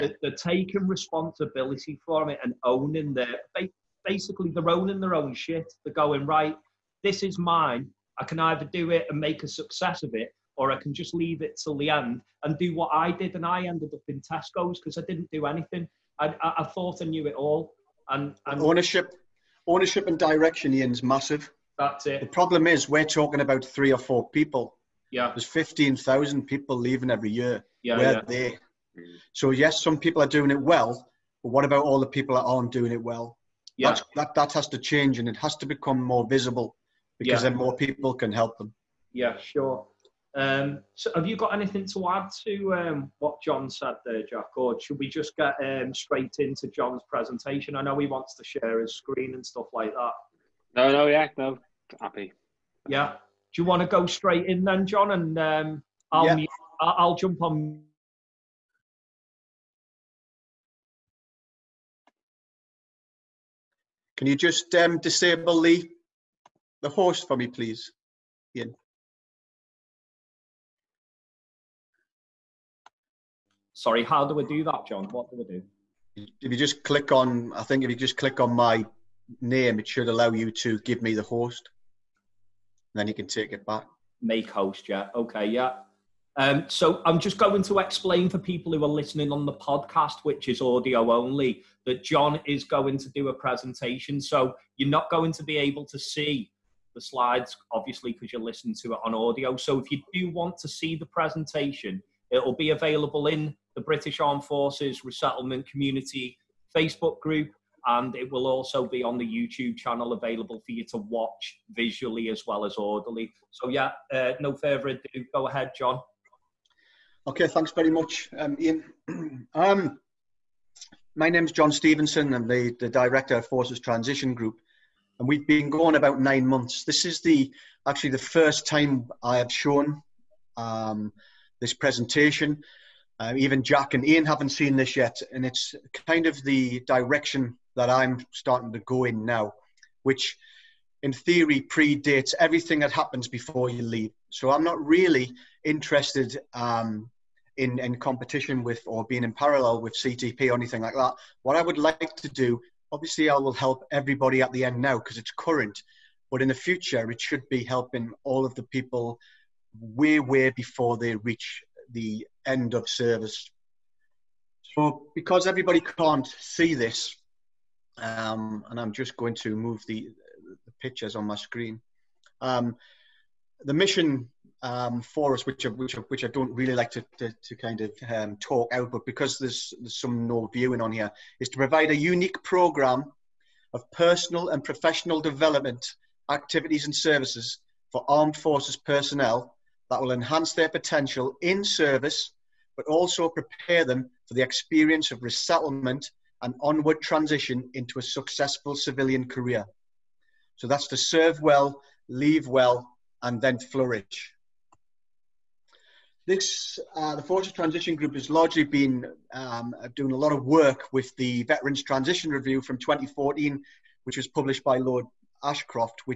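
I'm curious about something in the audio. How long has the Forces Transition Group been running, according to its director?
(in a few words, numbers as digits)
About nine months.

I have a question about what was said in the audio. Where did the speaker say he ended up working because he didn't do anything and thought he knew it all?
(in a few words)
Tesco's.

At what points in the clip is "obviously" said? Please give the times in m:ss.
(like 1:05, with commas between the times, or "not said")
1:37, 2:32.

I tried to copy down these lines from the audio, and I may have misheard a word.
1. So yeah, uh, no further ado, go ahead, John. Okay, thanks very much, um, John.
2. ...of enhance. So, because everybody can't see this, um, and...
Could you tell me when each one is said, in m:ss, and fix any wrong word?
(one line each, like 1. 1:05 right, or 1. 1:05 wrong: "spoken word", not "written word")
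1. 1:53 wrong: "Ian", not "John"
2. 2:42 wrong: "service", not "enhance".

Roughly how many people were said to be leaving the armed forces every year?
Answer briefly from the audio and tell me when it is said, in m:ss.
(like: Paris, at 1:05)
15,000, at 0:25.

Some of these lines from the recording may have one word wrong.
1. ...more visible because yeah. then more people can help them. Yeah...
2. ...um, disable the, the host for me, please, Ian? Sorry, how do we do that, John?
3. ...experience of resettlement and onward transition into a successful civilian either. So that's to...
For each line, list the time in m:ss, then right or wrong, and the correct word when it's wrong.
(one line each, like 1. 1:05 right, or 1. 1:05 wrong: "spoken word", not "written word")
1. 0:36 right
2. 1:04 right
3. 3:14 wrong: "career", not "either".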